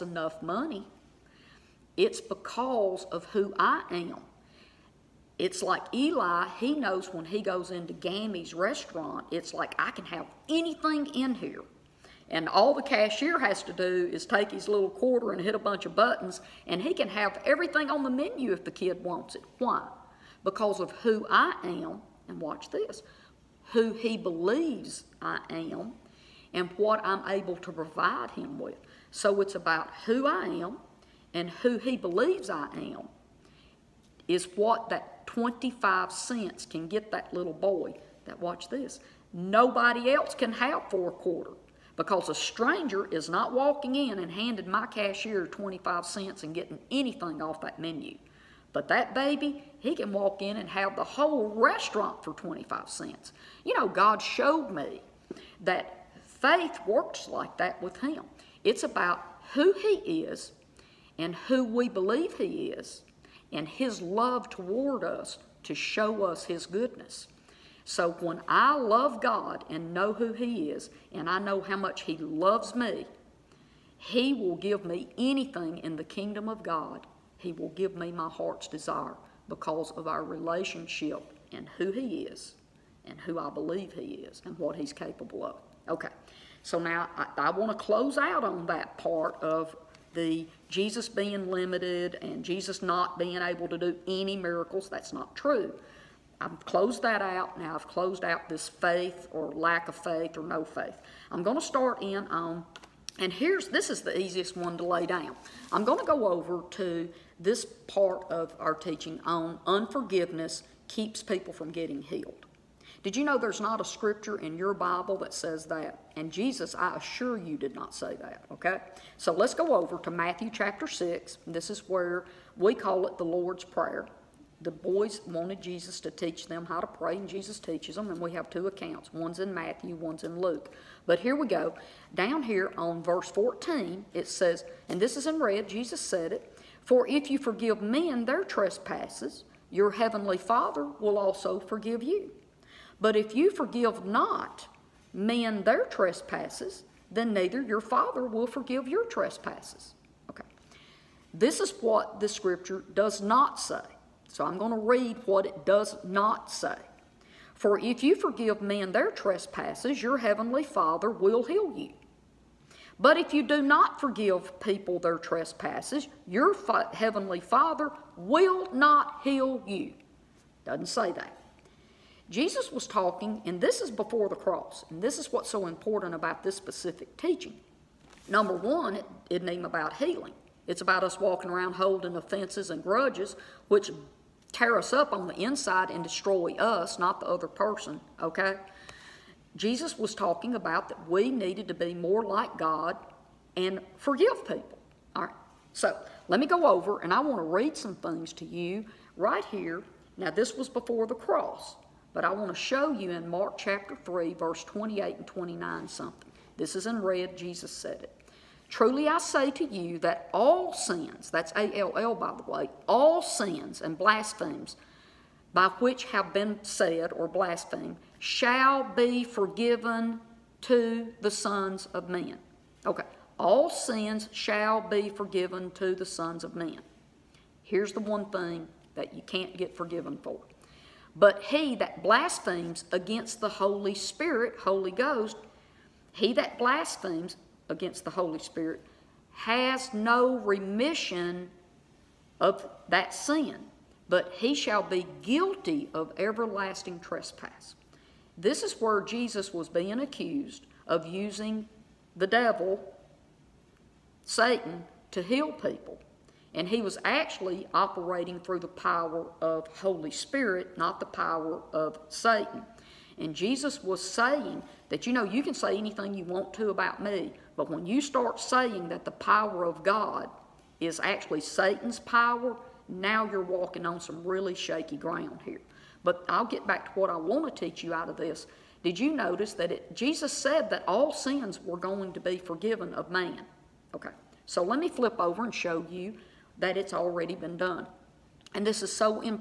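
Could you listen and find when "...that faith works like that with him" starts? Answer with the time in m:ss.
0:55.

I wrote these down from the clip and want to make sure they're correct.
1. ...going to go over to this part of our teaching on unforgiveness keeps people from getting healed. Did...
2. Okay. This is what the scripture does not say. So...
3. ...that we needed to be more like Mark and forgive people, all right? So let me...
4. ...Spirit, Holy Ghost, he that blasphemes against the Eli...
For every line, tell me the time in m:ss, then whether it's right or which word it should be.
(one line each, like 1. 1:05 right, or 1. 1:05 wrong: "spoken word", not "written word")
1. 1:45 right
2. 2:30 right
3. 3:10 wrong: "God", not "Mark"
4. 3:53 wrong: "Holy", not "Eli".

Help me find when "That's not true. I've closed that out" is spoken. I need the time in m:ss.
1:34.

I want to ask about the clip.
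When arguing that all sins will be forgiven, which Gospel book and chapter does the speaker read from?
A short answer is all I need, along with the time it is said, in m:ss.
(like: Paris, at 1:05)
Mark 3, at 3:23.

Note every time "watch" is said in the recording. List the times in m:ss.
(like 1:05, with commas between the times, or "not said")
0:22, 0:38.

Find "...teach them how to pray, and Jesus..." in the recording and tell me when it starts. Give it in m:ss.
2:06.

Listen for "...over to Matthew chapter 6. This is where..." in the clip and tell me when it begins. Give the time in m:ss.
1:59.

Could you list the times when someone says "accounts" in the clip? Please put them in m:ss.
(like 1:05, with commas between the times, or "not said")
2:08.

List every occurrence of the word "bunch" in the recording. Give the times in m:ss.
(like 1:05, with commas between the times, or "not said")
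0:15.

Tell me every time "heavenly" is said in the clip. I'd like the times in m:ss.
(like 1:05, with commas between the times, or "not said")
2:19, 2:40, 2:46.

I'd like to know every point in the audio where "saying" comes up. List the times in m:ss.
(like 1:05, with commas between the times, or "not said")
4:24, 4:28.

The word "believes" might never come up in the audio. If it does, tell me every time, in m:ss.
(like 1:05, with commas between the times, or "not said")
0:24, 0:31, 1:01, 1:23.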